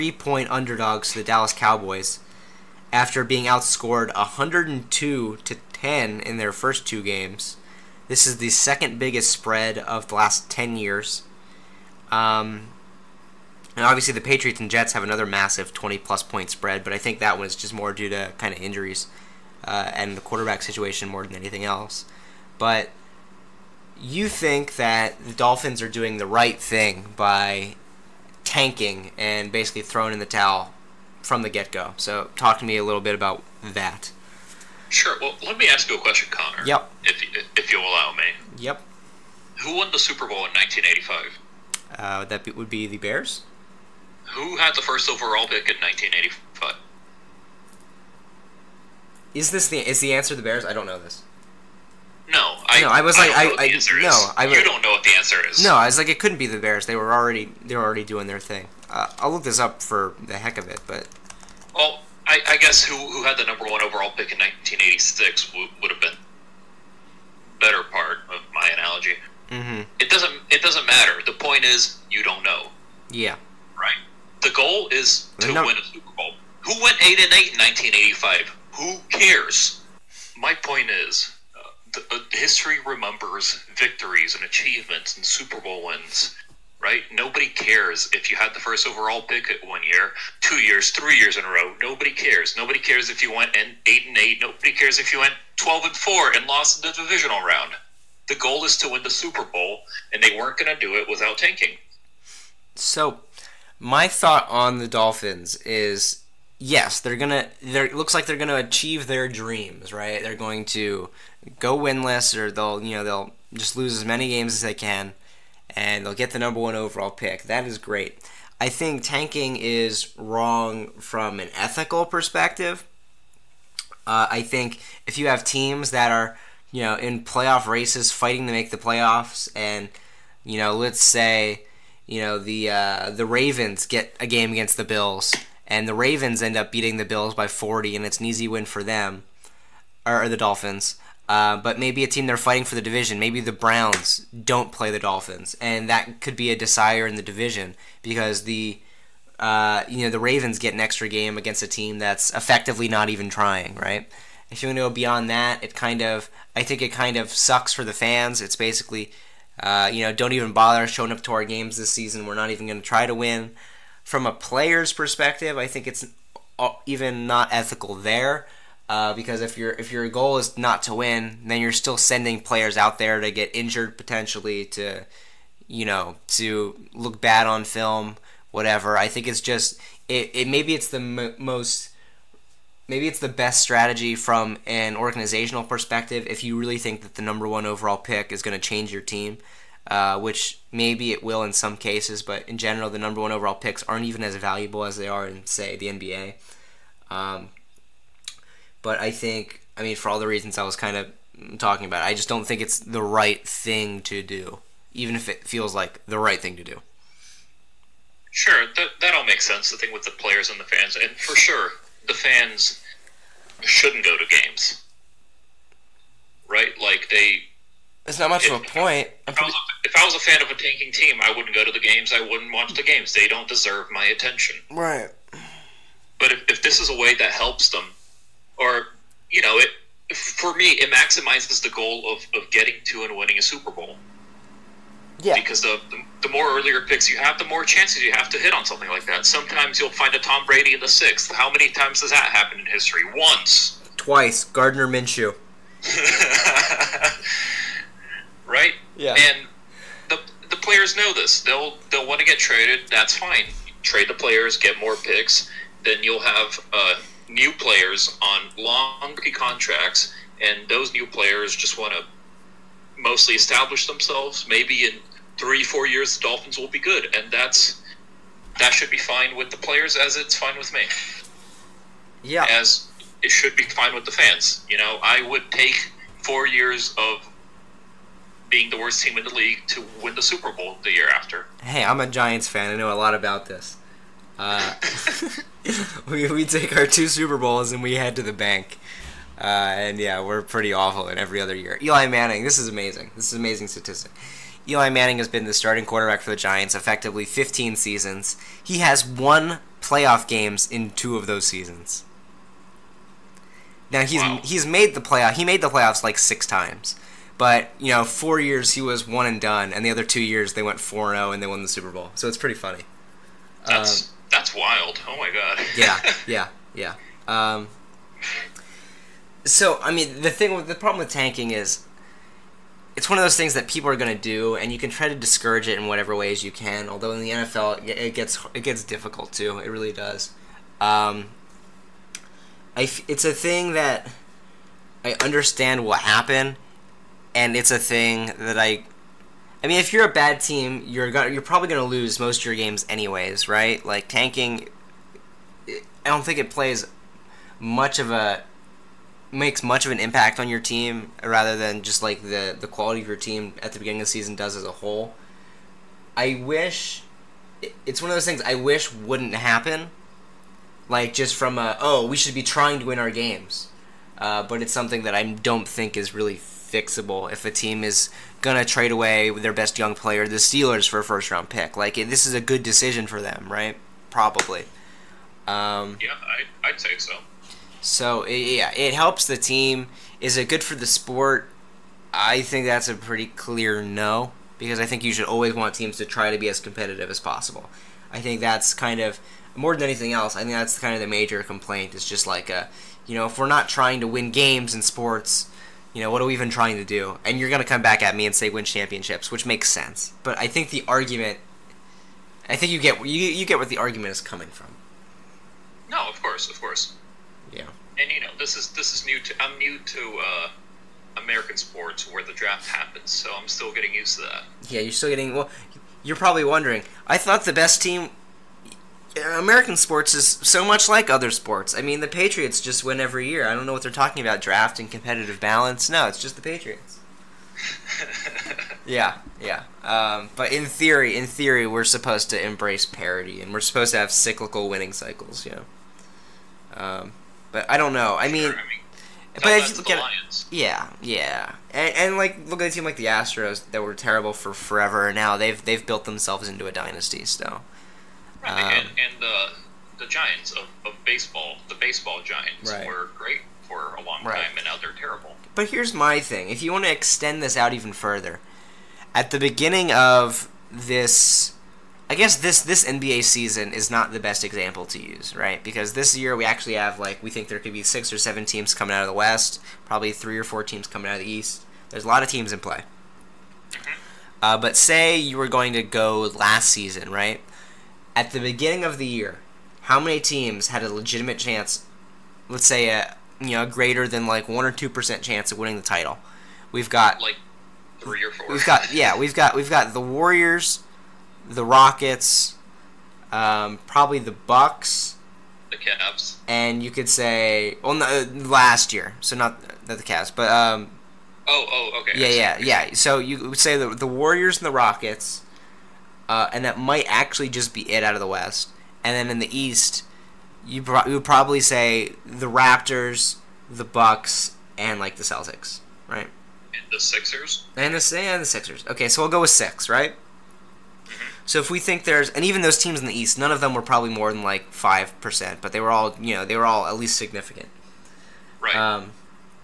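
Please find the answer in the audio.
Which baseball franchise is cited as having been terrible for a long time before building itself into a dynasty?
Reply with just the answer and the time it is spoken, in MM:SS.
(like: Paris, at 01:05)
Astros, at 07:23.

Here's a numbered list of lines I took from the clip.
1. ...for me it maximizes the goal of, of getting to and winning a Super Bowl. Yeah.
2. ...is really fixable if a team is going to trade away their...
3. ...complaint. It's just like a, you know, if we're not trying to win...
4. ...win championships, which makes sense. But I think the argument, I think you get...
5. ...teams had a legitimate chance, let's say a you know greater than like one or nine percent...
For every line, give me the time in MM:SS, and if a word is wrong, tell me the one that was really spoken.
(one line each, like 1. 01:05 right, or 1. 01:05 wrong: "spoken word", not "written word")
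1. 03:50 right
2. 06:05 right
3. 06:31 right
4. 06:38 right
5. 08:00 wrong: "two", not "nine".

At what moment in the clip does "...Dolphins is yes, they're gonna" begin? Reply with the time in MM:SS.
01:44.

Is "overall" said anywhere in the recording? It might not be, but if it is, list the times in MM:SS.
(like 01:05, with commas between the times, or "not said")
00:45, 01:03, 01:28, 01:56, 03:07, 03:13.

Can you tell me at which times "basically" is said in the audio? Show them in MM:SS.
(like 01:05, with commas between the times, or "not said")
00:29, 02:38.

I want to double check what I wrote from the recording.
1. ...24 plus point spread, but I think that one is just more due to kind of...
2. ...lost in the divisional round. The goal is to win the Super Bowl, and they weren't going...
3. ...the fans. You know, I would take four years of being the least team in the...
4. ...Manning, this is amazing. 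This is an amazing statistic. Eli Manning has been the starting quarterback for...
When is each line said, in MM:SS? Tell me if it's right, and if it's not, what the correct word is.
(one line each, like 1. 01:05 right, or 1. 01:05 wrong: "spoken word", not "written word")
1. 00:15 wrong: "20", not "24"
2. 01:36 right
3. 04:34 wrong: "worst", not "least"
4. 04:52 right.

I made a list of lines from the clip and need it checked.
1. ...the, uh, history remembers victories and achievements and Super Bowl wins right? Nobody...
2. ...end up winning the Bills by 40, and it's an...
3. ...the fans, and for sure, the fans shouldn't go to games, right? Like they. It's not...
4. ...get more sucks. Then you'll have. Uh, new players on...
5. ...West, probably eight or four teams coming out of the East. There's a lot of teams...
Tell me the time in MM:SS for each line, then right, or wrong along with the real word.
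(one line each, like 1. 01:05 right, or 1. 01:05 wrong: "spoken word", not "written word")
1. 01:21 right
2. 02:16 wrong: "beating", not "winning"
3. 03:30 right
4. 04:14 wrong: "picks", not "sucks"
5. 07:49 wrong: "three", not "eight".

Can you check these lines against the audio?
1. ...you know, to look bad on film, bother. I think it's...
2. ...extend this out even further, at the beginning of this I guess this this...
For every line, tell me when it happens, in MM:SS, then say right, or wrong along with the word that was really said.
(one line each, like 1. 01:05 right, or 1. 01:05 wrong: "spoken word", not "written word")
1. 02:55 wrong: "whatever", not "bother"
2. 07:36 right.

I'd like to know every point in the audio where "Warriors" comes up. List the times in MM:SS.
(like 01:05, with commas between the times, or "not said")
08:09, 08:24.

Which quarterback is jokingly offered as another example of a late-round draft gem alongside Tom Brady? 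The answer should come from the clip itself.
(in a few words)
Gardner Minshew.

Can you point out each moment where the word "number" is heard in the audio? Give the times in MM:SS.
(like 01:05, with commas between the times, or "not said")
01:03, 01:56, 03:07, 03:12.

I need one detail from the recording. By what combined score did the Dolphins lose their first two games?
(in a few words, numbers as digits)
102 to 10.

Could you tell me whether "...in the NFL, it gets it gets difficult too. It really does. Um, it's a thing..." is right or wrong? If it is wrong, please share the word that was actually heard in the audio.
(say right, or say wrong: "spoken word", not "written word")
right.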